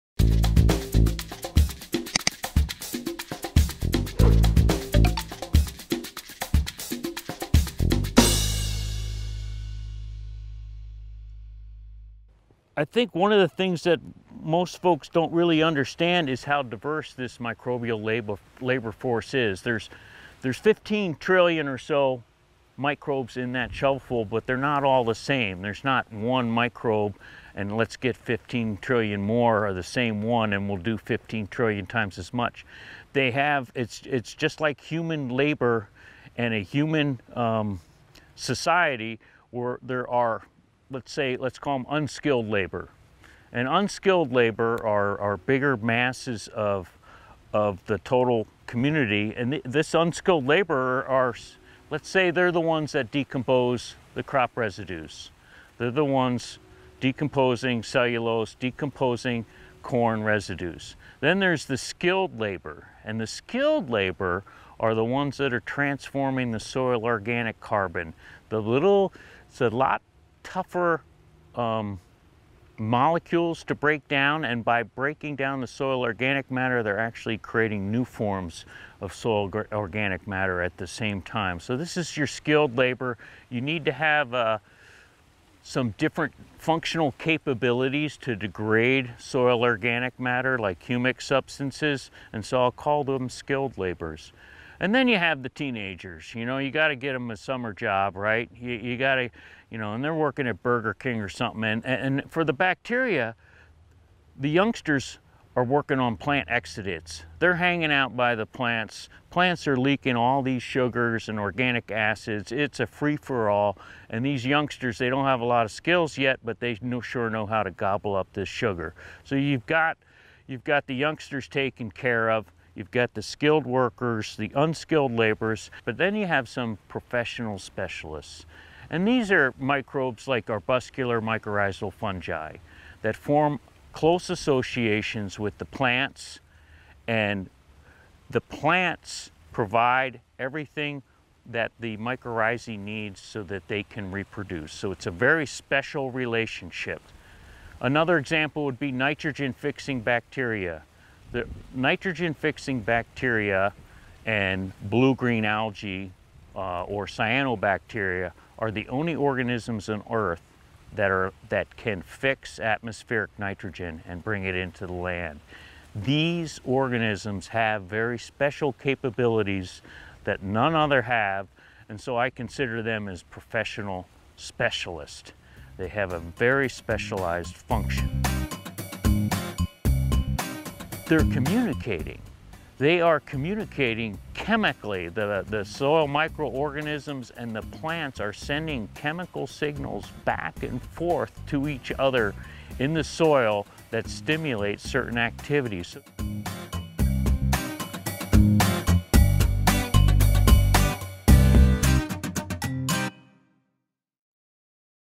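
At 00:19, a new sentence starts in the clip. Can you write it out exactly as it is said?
There's, there's 15 trillion or so microbes in that shovelful, but they're not all the same.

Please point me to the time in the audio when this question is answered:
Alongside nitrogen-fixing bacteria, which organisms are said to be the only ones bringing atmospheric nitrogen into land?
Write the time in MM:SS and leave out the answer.
02:37.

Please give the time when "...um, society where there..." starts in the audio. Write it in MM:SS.
00:37.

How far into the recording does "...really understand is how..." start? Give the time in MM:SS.
00:15.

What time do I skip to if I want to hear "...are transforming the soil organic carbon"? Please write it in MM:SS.
01:05.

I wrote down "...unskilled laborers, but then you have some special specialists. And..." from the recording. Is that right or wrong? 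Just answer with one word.
wrong.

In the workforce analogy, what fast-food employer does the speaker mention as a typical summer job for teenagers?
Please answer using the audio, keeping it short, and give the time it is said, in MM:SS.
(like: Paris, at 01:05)
Burger King, at 01:40.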